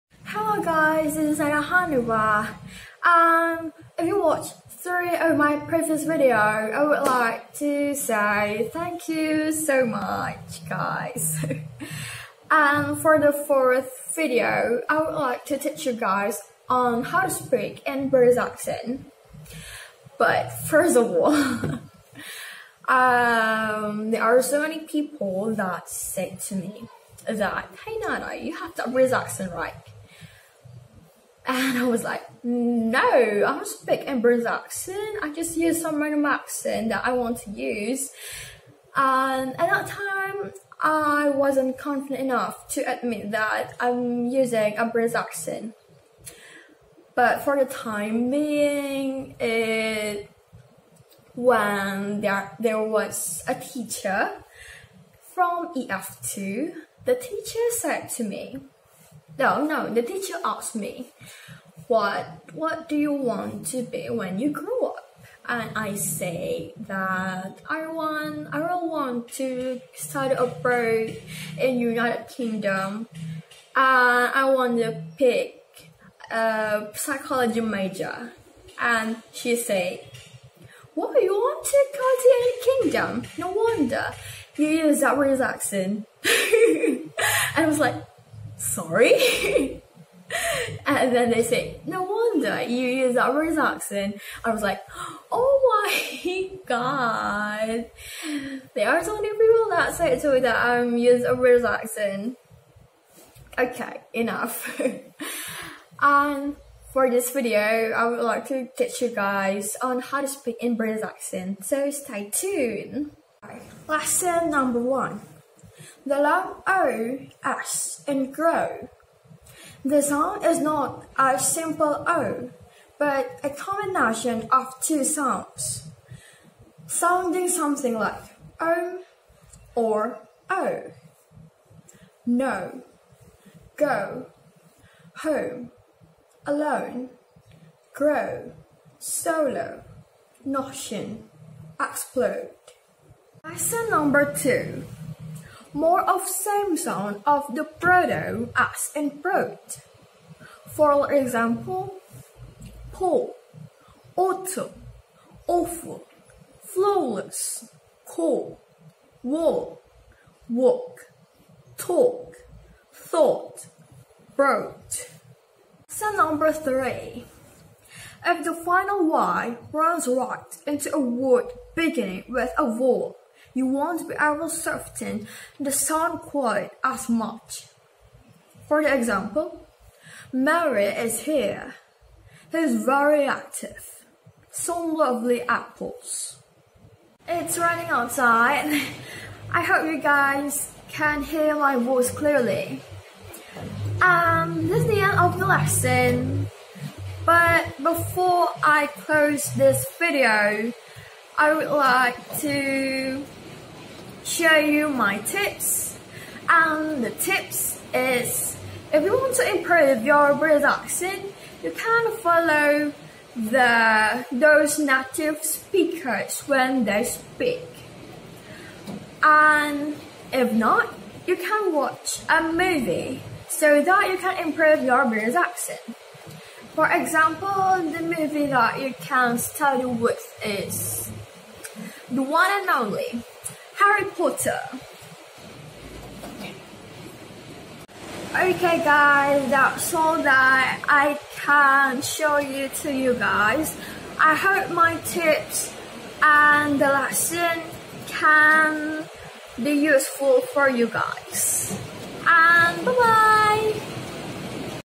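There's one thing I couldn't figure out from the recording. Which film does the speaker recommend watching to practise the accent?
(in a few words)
Harry Potter.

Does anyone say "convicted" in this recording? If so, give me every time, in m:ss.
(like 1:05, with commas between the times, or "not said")
not said.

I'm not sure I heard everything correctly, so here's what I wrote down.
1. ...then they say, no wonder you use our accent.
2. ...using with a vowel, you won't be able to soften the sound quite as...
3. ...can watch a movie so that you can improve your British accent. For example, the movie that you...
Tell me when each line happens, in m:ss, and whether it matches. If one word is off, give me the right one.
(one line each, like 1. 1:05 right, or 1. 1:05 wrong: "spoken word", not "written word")
1. 1:31 right
2. 2:51 wrong: "beginning", not "using"
3. 3:41 right.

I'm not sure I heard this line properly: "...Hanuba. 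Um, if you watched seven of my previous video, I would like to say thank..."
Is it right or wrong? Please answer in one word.
wrong.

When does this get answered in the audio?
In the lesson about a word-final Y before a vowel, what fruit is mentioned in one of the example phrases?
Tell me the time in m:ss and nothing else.
3:05.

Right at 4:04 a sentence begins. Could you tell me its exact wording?
I hope my tips and the lesson can be useful for you guys.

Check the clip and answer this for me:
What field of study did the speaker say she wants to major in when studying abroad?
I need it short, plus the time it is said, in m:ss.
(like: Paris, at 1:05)
psychology, at 1:16.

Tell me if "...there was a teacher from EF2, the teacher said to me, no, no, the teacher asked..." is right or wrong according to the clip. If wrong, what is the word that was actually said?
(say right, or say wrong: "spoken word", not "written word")
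right.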